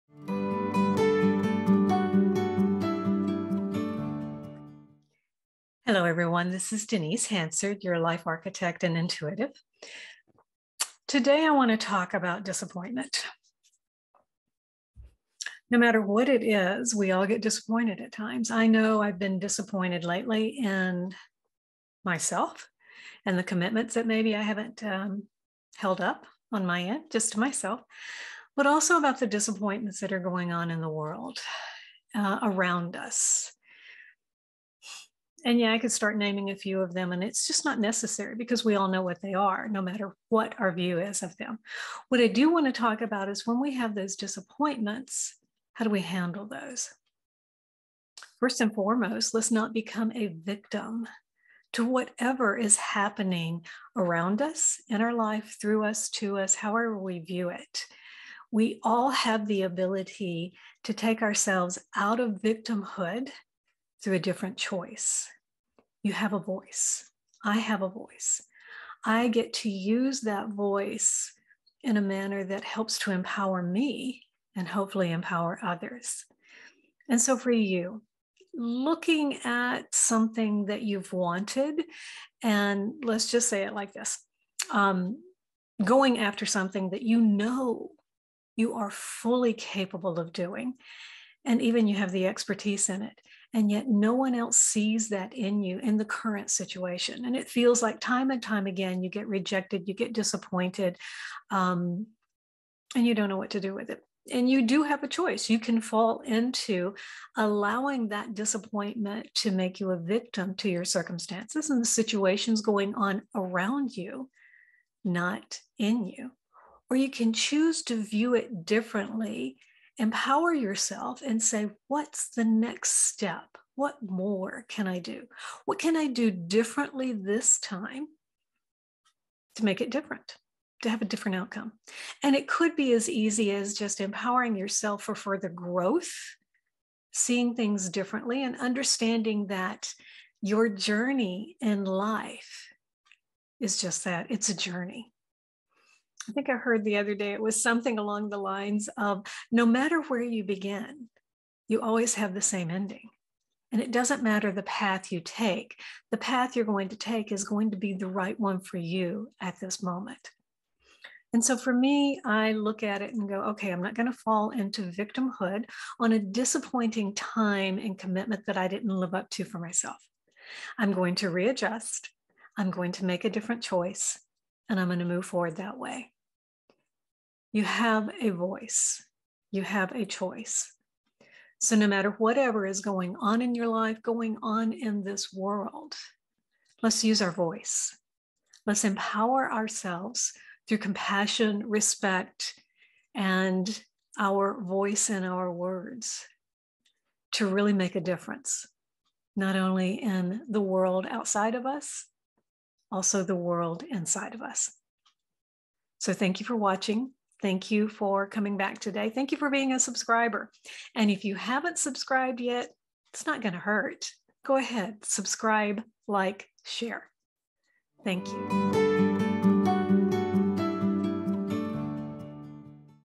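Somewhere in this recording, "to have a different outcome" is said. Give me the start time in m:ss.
2:10.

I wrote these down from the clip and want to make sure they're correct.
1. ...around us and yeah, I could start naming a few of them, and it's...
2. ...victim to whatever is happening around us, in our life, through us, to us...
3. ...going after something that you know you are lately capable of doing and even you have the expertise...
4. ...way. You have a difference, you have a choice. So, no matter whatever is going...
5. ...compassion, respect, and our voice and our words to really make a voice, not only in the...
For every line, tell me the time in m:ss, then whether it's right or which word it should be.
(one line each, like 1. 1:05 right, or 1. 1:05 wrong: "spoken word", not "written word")
1. 0:32 right
2. 0:50 right
3. 1:25 wrong: "fully", not "lately"
4. 2:55 wrong: "voice", not "difference"
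5. 3:10 wrong: "difference", not "voice".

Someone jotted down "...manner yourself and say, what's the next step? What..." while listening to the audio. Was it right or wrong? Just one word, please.
wrong.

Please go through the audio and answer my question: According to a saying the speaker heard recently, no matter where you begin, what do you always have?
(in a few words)
the same ending.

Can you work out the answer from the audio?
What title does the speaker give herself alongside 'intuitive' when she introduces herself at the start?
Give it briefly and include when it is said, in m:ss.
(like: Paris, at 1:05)
life architect, at 0:07.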